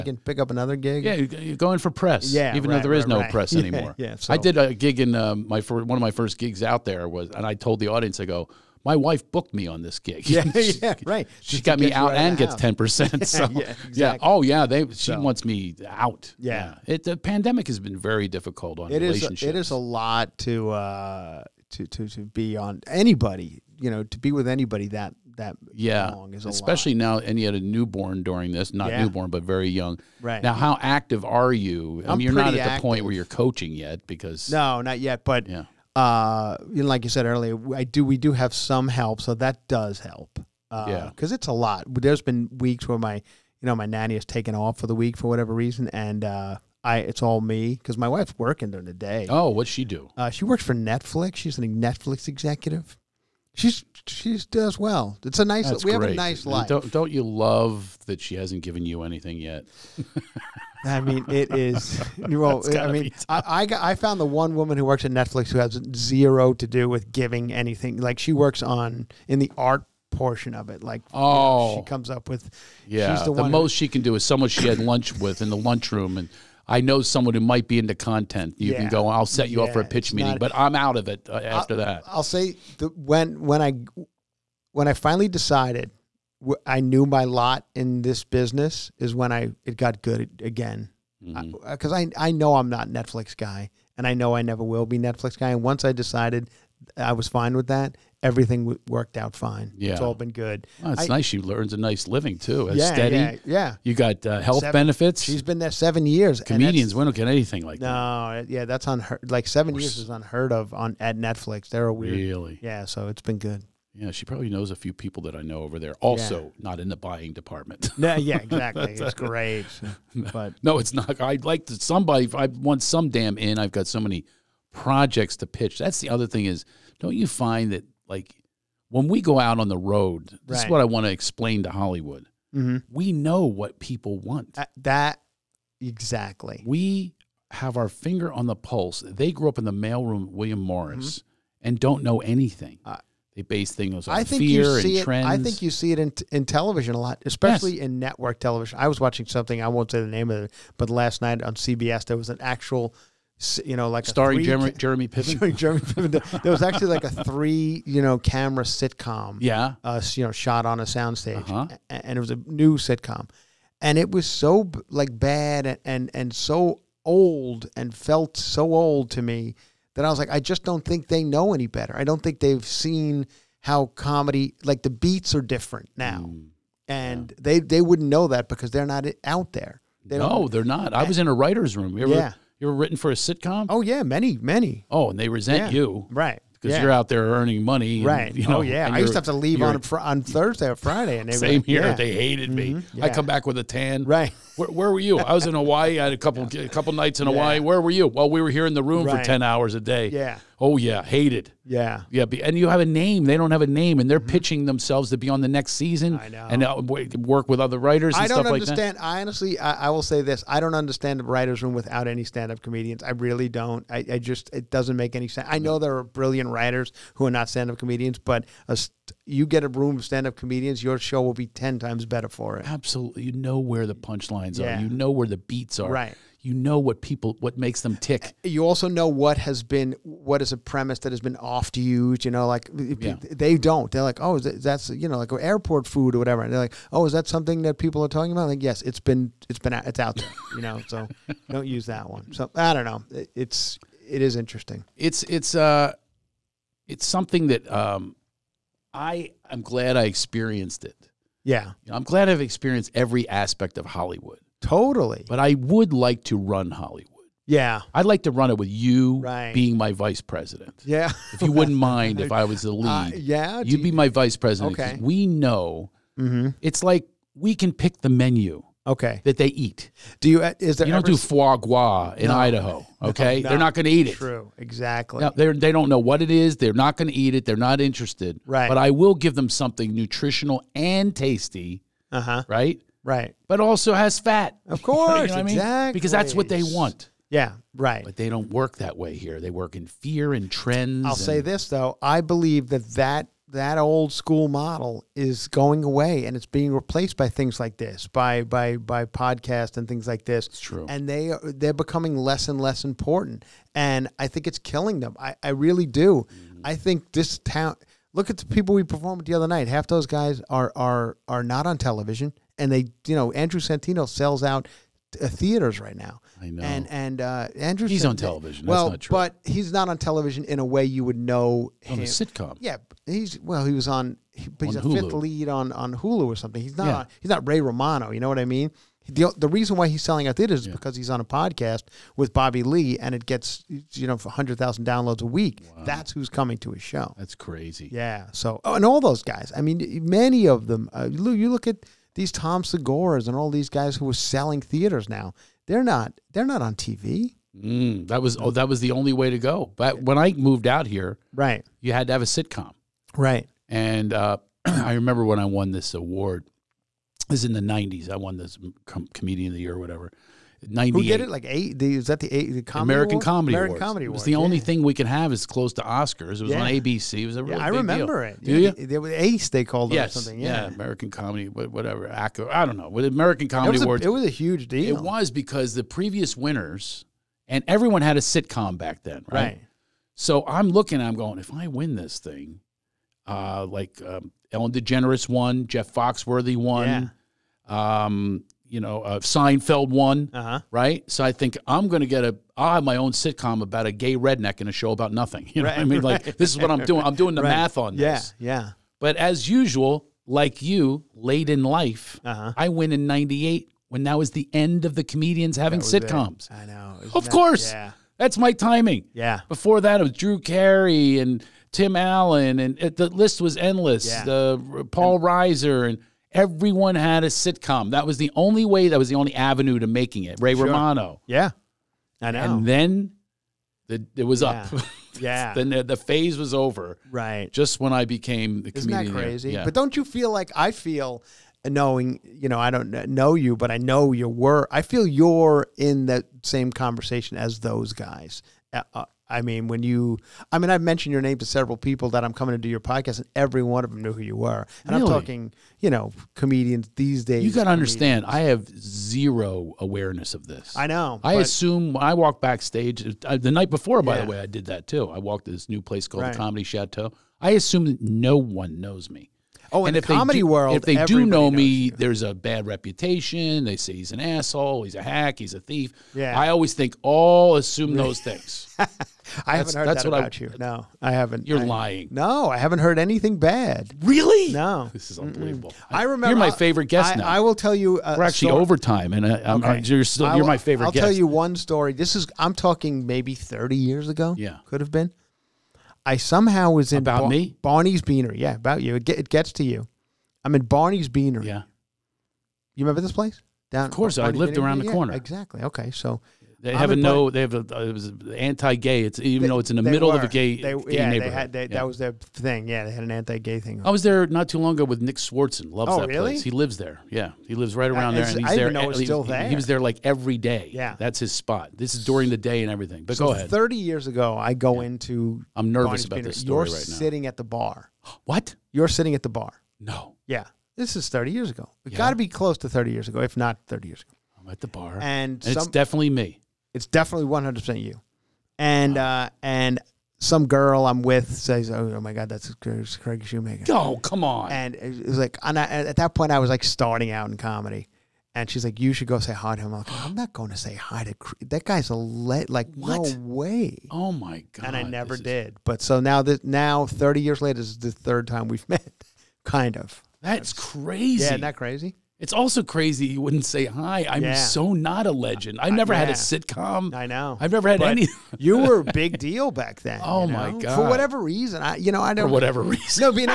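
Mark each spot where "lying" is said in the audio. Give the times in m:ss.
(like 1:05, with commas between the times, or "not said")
7:51.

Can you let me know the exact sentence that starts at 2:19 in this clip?
They grew up in the mailroom, William Morris, mm -hmm.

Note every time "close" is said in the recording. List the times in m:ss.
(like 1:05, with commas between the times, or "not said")
6:05, 8:42.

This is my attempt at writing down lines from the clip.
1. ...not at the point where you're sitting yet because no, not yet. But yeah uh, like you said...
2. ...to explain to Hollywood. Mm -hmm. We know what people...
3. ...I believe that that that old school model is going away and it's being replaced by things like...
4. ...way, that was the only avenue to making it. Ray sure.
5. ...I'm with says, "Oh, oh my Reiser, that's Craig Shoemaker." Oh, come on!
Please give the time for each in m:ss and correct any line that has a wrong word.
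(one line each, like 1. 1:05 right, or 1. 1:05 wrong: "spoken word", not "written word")
1. 0:32 wrong: "coaching", not "sitting"
2. 2:11 right
3. 4:52 right
4. 6:58 right
5. 8:50 wrong: "God", not "Reiser".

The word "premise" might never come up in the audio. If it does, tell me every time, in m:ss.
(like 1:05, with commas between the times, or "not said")
3:50.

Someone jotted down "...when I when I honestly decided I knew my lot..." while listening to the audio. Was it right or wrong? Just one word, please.
wrong.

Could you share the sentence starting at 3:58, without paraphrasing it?
Like, yes, it's been it's been it's out there.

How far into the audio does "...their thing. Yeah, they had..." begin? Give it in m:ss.
8:21.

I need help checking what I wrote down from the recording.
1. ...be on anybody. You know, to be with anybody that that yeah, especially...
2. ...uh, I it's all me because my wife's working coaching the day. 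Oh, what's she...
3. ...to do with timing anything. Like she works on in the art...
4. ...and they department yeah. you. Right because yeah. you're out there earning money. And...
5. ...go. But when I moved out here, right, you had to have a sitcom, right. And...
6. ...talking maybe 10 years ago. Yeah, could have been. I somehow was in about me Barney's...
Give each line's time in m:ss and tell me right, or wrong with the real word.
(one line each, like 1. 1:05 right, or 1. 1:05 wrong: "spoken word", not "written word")
1. 0:22 right
2. 0:46 wrong: "during", not "coaching"
3. 1:06 wrong: "giving", not "timing"
4. 3:05 wrong: "resent", not "department"
5. 5:49 right
6. 8:02 wrong: "30", not "10".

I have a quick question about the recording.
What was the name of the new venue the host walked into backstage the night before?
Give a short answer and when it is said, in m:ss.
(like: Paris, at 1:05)
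Comedy Chateau, at 7:36.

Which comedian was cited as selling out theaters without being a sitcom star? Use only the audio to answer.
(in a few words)
Andrew Santino.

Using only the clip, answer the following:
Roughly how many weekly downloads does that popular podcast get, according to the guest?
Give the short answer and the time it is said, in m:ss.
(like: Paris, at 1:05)
100,000, at 5:34.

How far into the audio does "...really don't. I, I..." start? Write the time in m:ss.
3:33.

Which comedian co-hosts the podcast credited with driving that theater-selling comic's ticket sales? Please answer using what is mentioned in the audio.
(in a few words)
Bobby Lee.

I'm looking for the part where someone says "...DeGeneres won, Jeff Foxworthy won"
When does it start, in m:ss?
6:24.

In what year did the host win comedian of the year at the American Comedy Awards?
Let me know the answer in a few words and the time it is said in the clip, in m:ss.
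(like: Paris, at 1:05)
1998, at 6:43.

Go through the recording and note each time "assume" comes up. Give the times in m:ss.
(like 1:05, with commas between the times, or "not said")
7:31, 7:37, 7:47.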